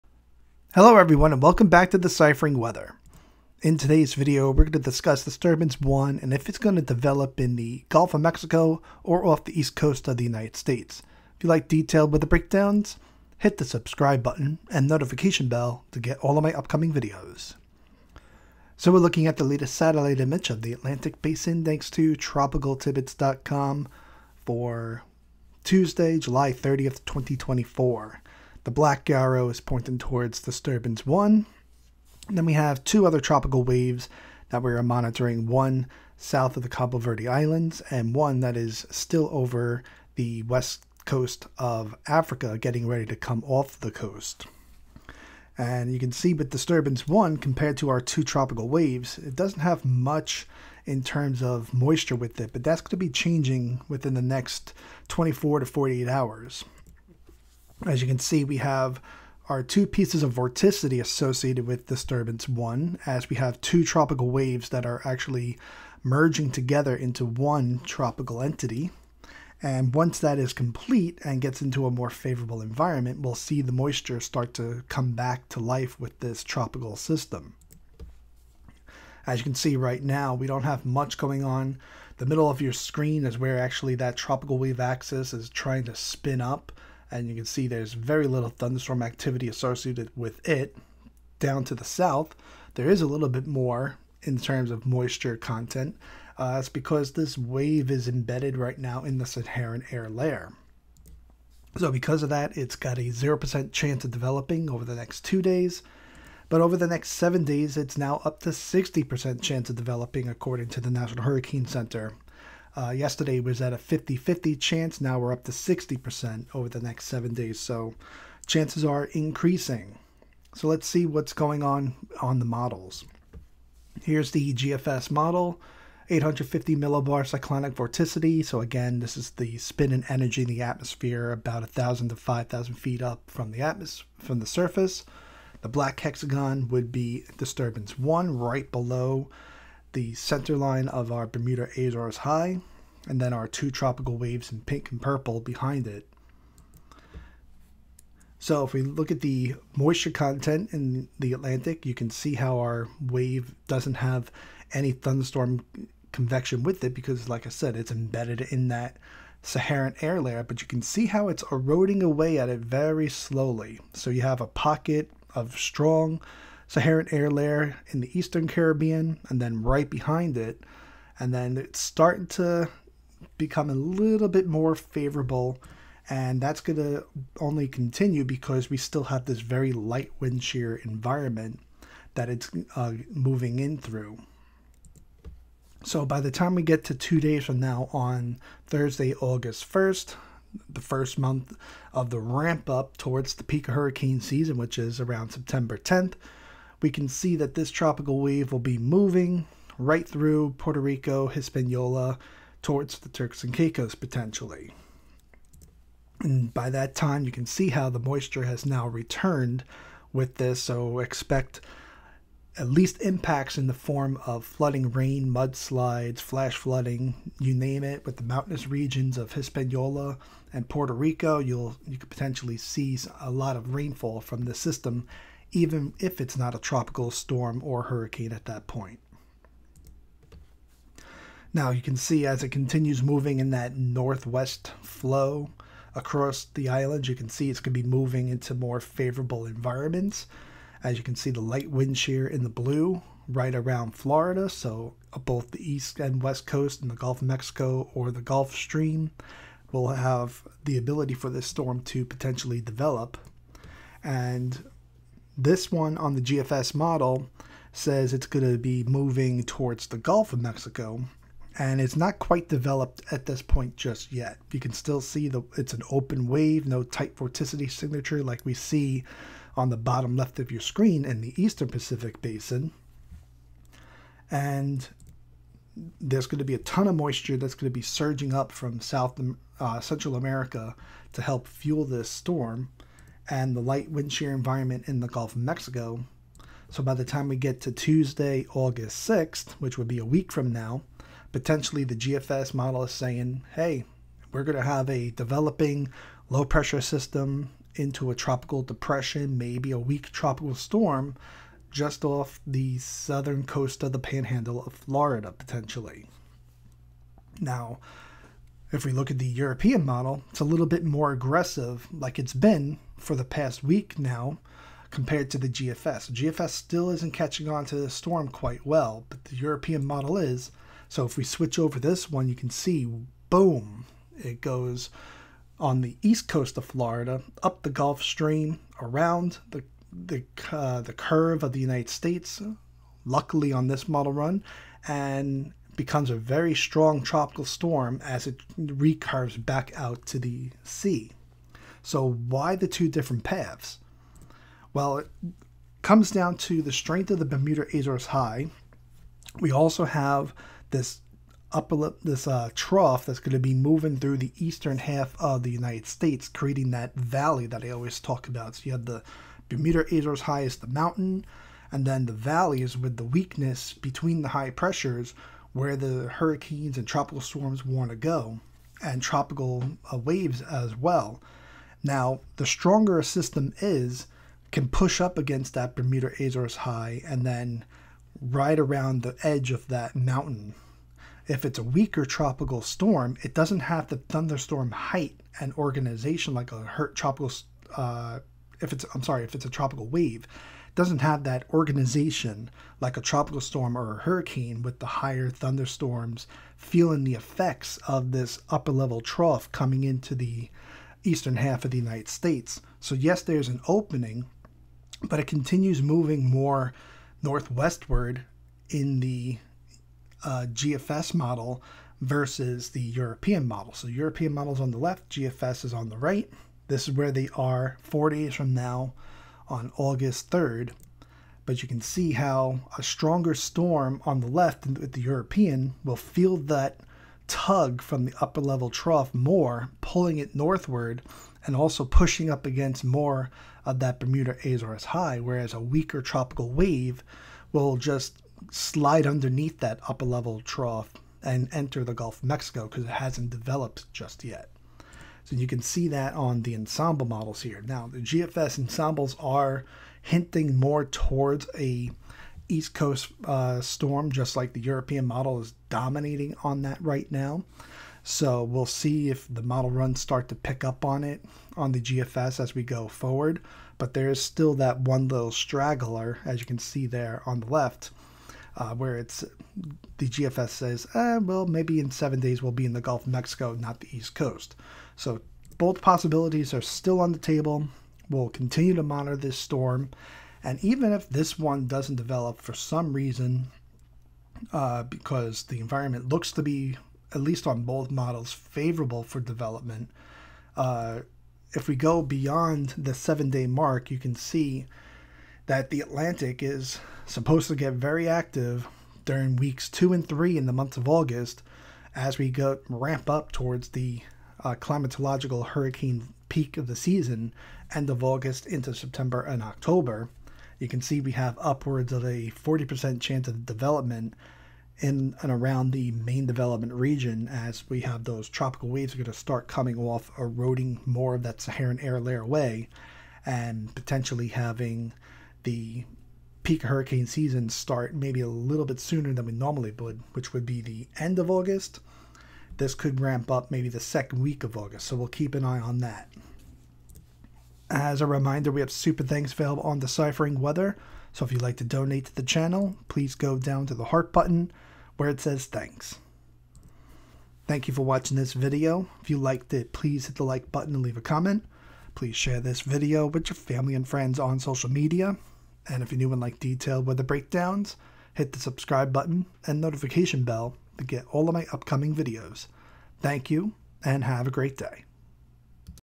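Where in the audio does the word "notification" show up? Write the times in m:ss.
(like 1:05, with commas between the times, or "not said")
0:14, 9:19.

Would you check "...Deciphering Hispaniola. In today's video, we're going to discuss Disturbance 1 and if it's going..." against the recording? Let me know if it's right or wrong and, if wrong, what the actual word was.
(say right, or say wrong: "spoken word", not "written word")
wrong: "Weather", not "Hispaniola".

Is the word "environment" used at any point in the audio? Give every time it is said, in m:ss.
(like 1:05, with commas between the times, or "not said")
1:12, 3:00, 3:59, 4:44, 8:05.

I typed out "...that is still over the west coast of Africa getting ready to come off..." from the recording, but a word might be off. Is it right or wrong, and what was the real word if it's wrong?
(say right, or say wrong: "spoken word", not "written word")
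right.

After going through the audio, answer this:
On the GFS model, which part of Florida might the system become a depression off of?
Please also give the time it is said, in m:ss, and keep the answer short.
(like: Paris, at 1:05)
the panhandle, at 5:03.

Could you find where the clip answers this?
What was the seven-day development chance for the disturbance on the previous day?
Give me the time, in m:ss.
1:53.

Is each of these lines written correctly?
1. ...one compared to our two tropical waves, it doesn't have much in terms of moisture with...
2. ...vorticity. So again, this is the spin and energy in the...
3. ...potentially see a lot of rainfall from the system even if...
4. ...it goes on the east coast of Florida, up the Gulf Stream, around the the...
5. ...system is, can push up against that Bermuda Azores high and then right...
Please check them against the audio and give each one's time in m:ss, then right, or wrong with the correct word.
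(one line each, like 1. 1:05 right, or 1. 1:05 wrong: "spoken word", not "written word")
1. 0:47 right
2. 2:07 right
3. 3:42 right
4. 5:24 right
5. 6:13 right.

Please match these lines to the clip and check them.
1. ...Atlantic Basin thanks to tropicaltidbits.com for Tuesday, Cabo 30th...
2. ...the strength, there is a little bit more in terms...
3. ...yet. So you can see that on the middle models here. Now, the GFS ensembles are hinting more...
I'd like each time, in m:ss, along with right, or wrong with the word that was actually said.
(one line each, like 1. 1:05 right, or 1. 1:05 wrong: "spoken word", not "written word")
1. 0:20 wrong: "July", not "Cabo"
2. 1:31 wrong: "south", not "strength"
3. 7:24 wrong: "ensemble", not "middle".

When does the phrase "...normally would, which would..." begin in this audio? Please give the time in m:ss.
8:49.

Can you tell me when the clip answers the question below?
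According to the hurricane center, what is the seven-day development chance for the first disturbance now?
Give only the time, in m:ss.
1:48.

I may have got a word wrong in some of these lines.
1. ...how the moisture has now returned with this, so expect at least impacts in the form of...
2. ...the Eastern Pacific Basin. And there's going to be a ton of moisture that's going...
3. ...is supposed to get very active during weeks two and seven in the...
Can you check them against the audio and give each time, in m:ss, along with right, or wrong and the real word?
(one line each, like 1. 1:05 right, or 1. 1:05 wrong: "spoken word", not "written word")
1. 3:27 right
2. 4:31 right
3. 8:16 wrong: "three", not "seven".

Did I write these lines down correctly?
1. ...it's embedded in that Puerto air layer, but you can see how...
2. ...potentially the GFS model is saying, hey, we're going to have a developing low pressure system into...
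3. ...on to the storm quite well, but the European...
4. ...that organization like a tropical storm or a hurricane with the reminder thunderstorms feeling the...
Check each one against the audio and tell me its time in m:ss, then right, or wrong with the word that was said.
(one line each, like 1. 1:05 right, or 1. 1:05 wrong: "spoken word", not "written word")
1. 2:37 wrong: "Saharan", not "Puerto"
2. 4:51 right
3. 5:17 right
4. 6:31 wrong: "higher", not "reminder".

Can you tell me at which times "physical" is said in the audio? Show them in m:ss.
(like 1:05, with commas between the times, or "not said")
not said.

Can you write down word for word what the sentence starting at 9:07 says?
Thank you for watching this video.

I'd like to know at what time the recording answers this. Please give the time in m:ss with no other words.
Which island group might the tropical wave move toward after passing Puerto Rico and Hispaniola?
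3:23.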